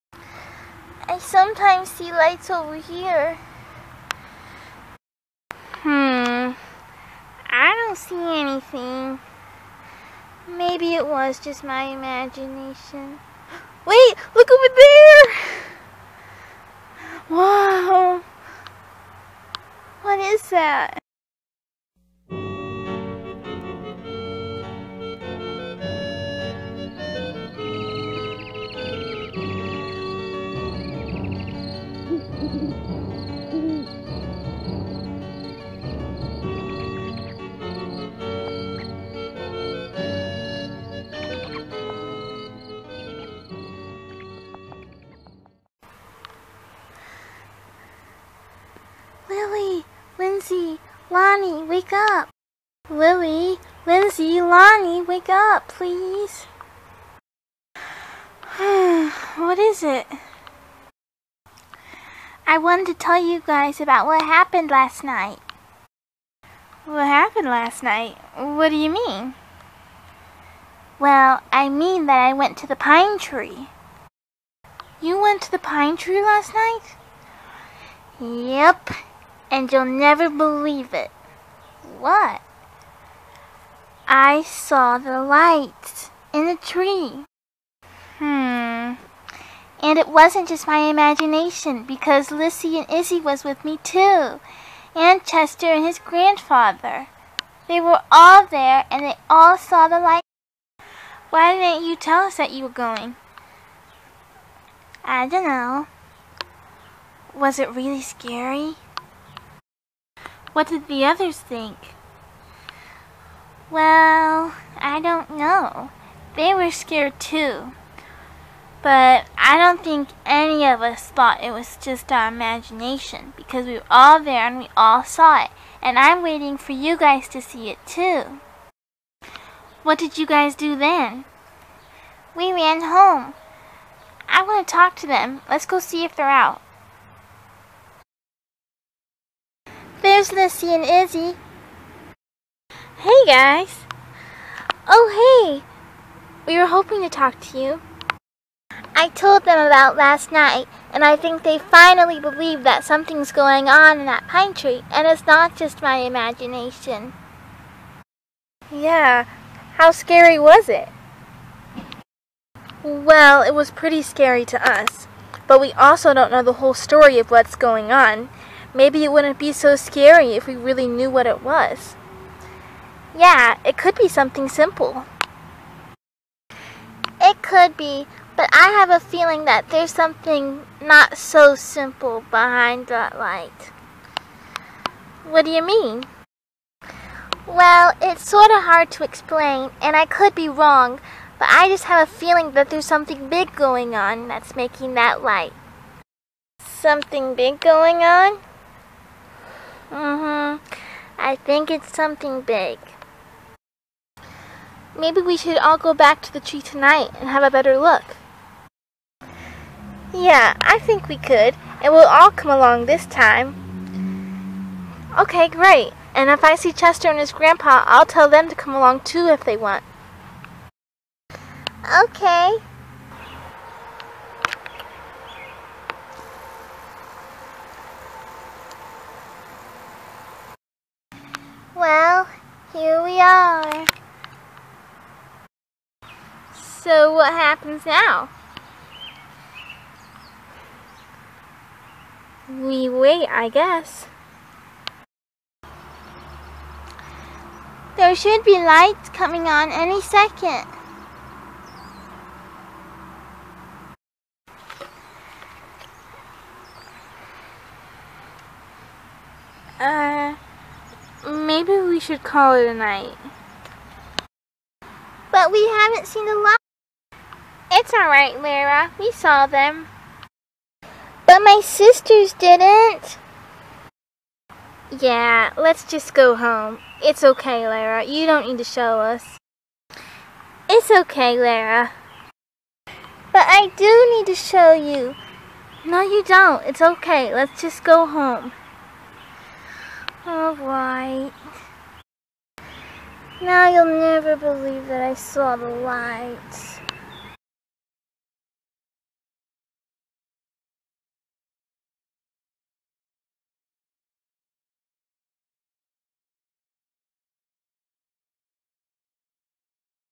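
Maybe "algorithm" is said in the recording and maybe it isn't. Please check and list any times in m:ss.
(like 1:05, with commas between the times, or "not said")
not said.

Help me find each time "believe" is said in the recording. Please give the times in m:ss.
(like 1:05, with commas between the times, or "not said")
1:20, 2:32, 4:54.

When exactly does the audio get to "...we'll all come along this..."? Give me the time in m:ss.
3:31.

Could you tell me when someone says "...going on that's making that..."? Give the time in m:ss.
3:13.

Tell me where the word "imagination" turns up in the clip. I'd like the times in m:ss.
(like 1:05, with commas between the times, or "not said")
0:11, 1:30, 2:02, 2:36.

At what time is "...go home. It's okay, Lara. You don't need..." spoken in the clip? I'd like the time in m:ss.
4:36.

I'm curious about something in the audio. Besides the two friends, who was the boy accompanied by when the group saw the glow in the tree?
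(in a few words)
His grandfather.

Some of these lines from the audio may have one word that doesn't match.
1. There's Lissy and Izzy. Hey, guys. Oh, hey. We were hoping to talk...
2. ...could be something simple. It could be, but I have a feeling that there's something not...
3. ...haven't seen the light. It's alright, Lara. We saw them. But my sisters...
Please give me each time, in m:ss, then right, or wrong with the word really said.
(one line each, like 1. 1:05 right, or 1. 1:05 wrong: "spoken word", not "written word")
1. 2:20 right
2. 2:53 right
3. 4:25 right.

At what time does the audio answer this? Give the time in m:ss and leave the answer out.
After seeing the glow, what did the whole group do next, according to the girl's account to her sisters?
2:12.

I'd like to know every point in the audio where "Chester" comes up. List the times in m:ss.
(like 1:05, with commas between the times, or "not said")
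1:35, 3:36.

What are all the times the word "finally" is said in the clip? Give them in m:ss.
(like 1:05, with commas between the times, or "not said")
2:31.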